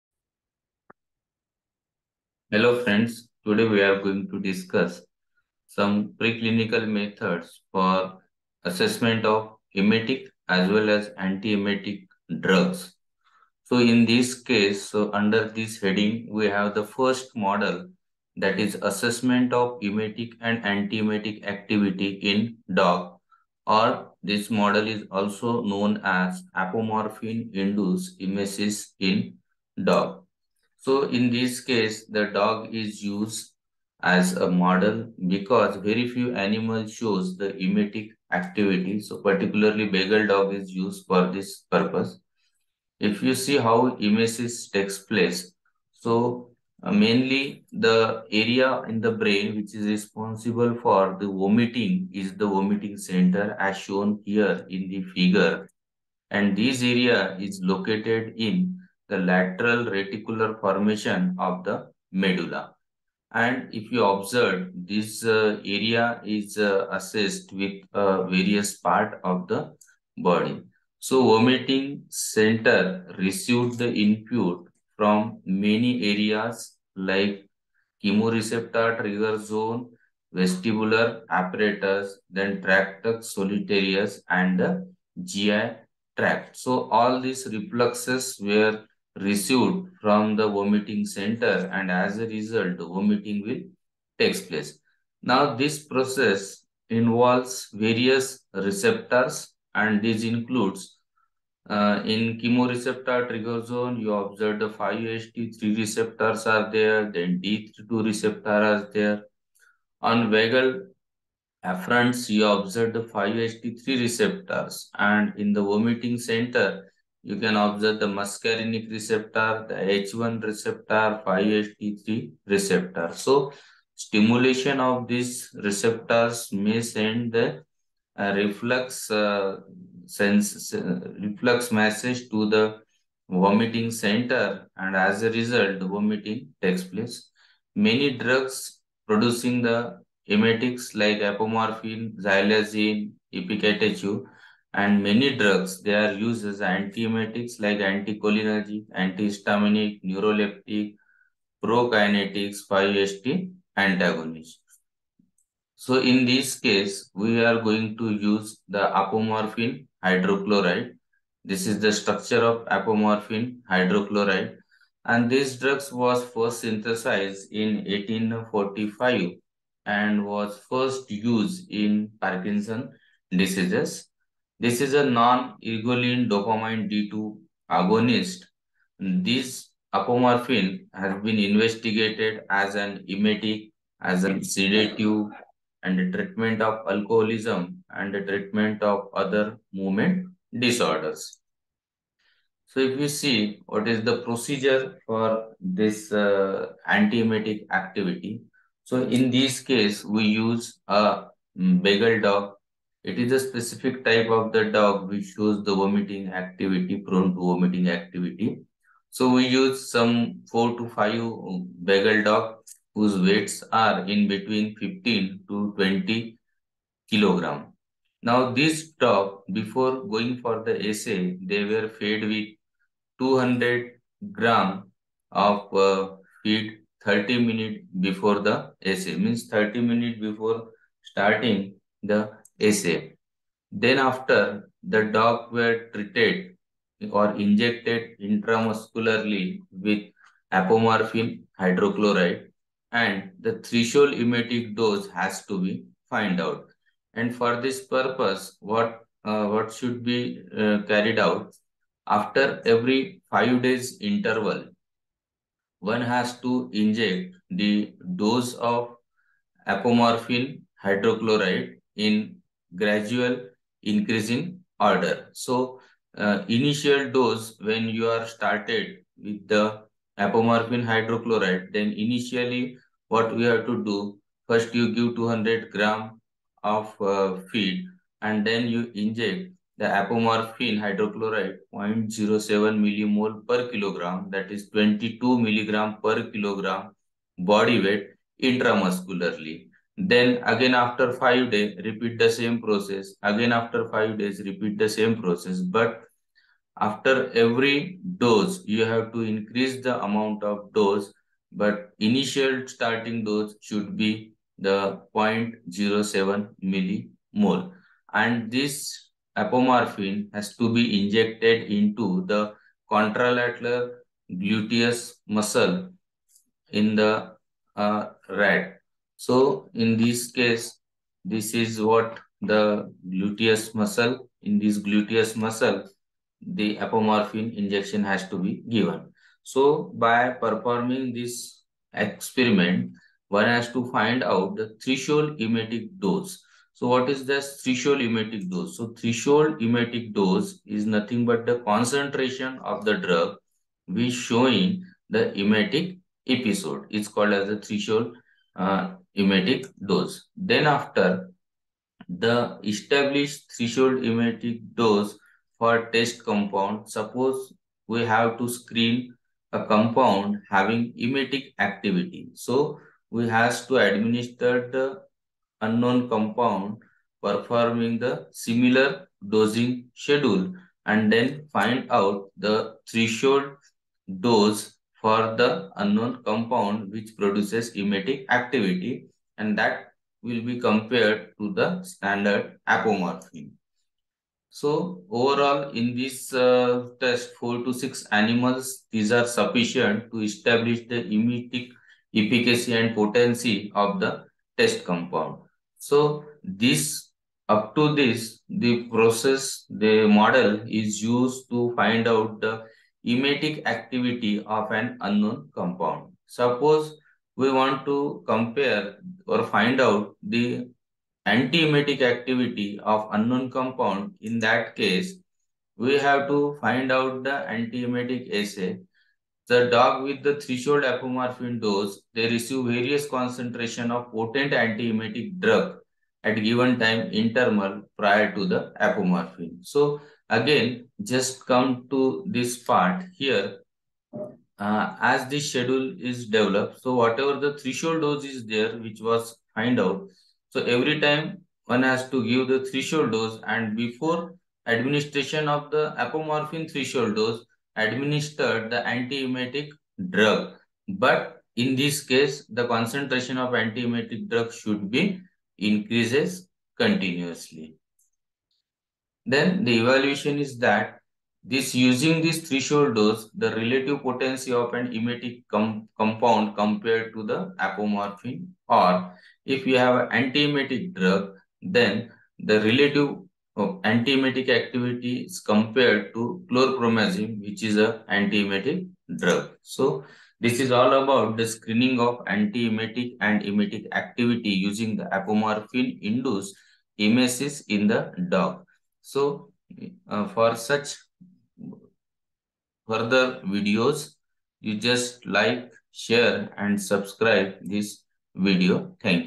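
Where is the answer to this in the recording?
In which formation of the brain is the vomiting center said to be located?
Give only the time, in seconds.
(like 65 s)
59 s.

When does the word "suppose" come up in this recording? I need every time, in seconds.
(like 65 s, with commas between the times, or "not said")
356 s, 406 s.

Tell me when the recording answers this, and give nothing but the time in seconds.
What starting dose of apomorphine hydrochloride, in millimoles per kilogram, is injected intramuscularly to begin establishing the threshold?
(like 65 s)
281 s.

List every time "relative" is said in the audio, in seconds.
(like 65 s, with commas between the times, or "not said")
463 s, 472 s.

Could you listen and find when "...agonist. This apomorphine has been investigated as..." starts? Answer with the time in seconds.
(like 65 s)
177 s.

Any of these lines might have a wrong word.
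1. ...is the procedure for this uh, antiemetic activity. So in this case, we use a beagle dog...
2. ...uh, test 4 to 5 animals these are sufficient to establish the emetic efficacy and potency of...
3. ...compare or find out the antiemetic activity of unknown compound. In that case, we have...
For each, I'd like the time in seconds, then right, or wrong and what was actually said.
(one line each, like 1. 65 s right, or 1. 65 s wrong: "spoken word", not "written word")
1. 193 s right
2. 386 s wrong: "6", not "5"
3. 408 s right.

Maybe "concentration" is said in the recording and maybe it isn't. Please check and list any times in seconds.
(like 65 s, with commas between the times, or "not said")
341 s, 423 s, 452 s.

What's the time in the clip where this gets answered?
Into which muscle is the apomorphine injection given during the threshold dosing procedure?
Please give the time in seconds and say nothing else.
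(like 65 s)
312 s.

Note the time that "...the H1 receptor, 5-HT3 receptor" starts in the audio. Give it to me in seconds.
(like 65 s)
119 s.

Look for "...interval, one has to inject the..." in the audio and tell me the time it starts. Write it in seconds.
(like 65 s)
254 s.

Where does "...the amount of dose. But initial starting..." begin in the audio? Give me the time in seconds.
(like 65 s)
299 s.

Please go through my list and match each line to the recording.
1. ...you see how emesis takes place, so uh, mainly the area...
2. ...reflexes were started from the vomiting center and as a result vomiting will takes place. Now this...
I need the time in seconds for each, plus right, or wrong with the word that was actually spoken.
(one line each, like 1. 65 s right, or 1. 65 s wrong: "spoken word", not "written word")
1. 43 s right
2. 87 s wrong: "received", not "started".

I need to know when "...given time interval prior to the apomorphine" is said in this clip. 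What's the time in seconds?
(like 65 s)
426 s.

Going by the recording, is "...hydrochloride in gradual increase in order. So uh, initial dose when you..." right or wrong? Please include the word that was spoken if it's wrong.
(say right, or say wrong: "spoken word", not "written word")
right.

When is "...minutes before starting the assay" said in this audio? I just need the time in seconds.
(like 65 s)
229 s.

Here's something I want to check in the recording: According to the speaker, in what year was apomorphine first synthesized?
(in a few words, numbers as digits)
1845.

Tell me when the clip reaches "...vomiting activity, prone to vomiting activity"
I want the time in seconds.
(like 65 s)
205 s.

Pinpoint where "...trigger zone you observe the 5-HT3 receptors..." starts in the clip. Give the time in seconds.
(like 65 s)
103 s.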